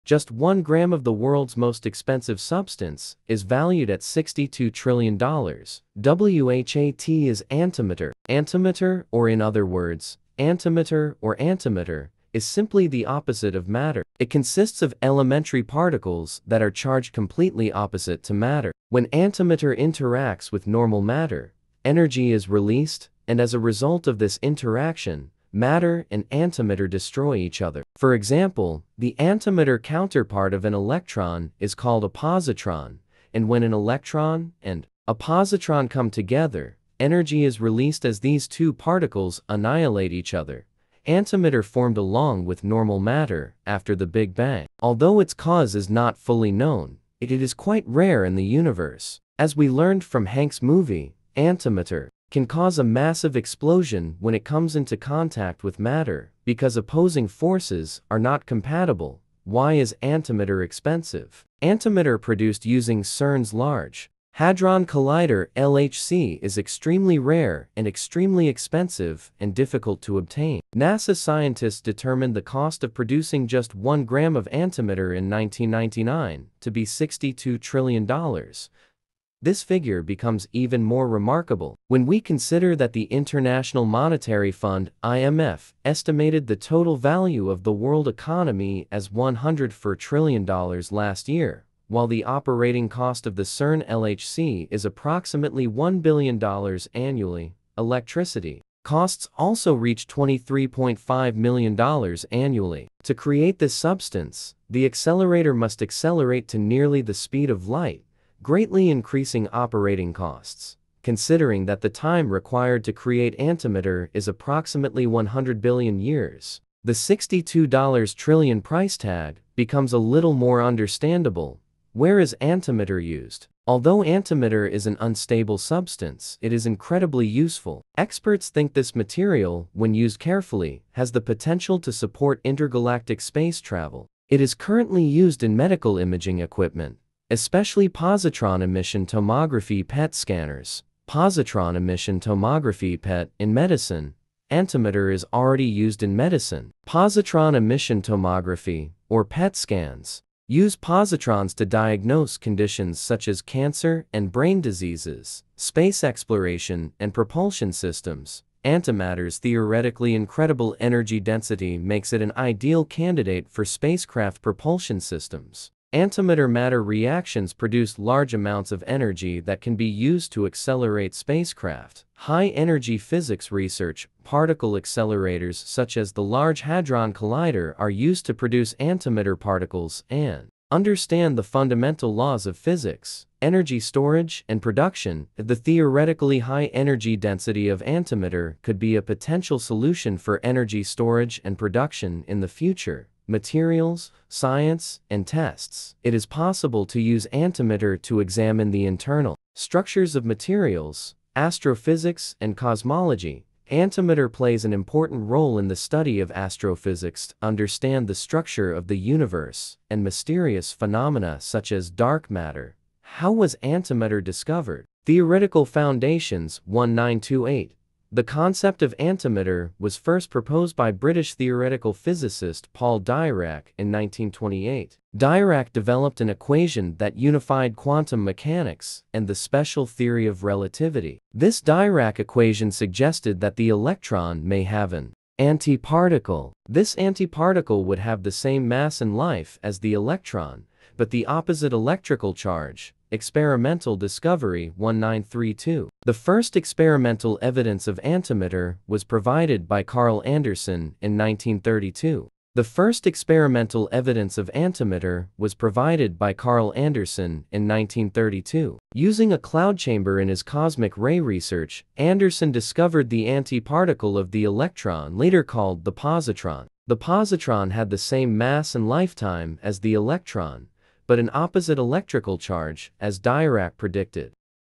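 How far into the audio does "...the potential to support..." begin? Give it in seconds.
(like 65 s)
131 s.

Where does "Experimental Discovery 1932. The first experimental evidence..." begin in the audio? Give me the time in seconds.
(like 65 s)
243 s.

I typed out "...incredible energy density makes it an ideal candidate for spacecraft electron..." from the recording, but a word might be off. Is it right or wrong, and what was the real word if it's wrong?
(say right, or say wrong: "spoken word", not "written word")
wrong: "propulsion", not "electron".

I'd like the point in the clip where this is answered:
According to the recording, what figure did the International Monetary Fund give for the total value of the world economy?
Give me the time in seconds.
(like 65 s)
89 s.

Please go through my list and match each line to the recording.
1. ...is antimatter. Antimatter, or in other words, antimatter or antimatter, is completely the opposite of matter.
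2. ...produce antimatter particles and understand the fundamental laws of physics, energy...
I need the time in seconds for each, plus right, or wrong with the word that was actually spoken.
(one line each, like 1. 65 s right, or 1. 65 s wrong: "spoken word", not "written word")
1. 7 s wrong: "simply", not "completely"
2. 178 s right.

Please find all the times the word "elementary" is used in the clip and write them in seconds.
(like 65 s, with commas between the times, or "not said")
15 s.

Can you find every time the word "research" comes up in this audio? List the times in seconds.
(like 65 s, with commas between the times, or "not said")
173 s, 261 s.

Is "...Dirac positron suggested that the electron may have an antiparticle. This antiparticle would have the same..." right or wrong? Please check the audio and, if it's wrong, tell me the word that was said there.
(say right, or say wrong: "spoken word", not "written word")
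wrong: "equation", not "positron".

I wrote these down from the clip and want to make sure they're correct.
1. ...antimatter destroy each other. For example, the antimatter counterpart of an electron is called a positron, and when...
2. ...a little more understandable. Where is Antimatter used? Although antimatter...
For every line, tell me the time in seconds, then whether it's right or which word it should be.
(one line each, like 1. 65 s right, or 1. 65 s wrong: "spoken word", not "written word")
1. 26 s right
2. 119 s right.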